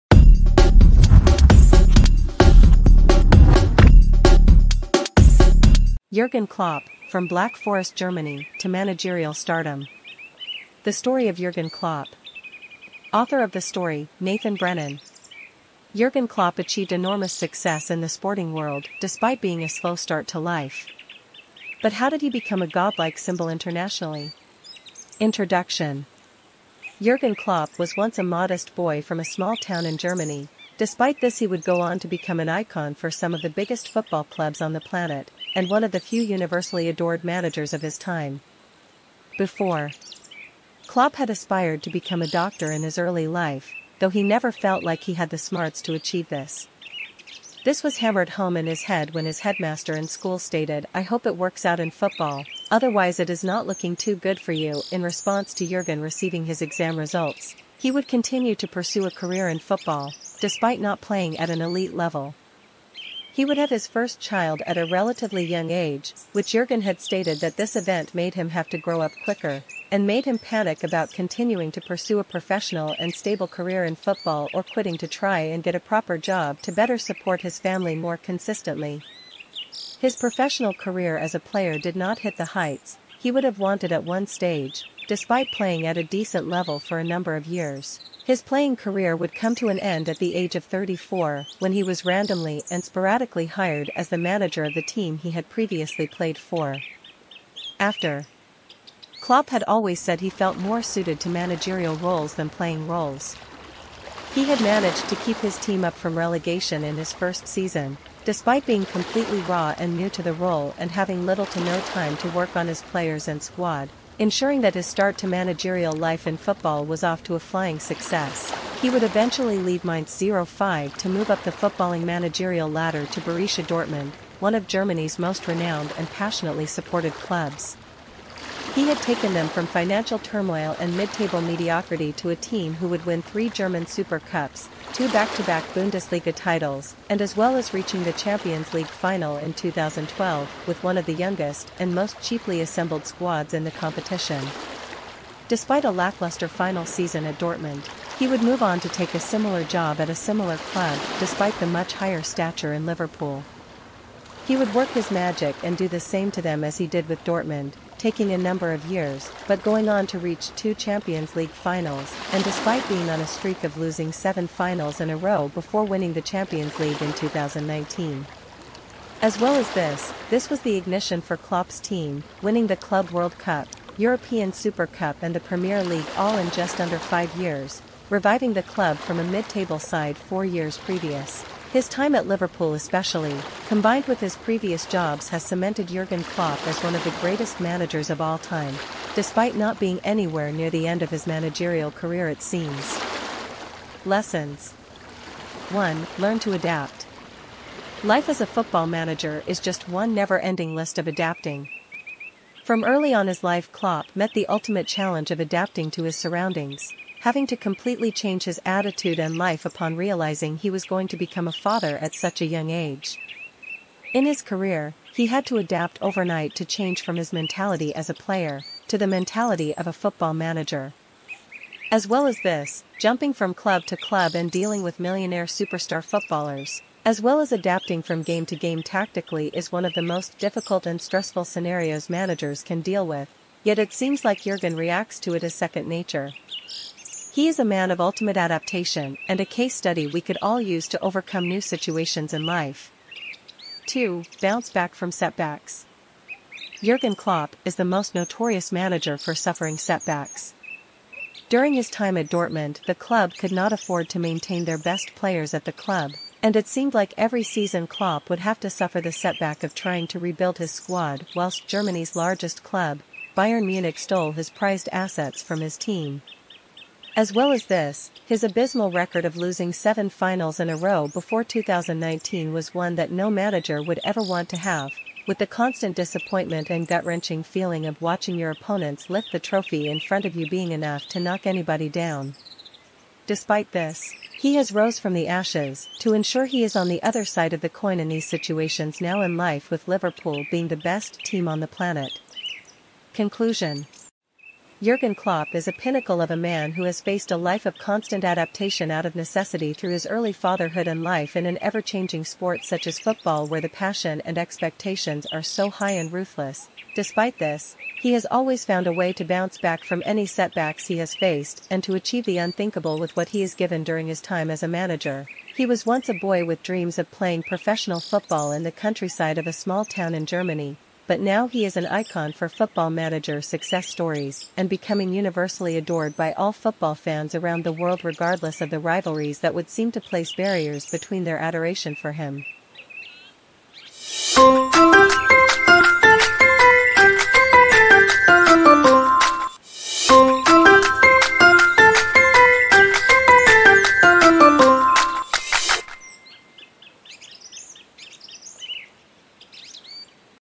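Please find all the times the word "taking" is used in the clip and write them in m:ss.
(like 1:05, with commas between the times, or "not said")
2:38.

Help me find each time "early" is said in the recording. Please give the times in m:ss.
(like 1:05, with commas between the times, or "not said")
0:42, 3:22, 5:00.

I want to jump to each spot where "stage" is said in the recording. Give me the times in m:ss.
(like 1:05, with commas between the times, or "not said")
1:24.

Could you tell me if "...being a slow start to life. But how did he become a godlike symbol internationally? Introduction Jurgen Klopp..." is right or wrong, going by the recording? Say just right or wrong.
right.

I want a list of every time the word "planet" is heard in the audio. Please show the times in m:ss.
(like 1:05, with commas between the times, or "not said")
0:34, 4:51.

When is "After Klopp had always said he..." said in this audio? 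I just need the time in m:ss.
1:37.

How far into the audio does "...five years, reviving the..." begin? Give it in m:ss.
2:56.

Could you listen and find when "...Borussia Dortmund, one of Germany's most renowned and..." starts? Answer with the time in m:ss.
2:03.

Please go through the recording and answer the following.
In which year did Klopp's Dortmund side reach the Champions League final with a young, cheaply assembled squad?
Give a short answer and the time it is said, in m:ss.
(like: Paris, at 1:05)
2012, at 2:19.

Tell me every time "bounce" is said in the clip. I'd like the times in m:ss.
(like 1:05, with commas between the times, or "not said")
4:04, 5:09.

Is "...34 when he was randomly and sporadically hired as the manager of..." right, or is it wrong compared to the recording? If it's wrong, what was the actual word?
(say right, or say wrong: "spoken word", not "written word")
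right.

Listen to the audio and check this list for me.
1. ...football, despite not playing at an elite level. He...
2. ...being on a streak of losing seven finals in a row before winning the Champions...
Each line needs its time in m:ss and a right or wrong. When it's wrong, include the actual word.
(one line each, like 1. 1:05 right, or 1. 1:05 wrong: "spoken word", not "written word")
1. 0:59 right
2. 2:42 right.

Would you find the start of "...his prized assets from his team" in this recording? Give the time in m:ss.
4:24.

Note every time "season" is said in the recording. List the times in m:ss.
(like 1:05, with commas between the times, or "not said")
1:47, 2:26, 4:17.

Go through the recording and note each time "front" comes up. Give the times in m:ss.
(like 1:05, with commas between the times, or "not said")
4:39.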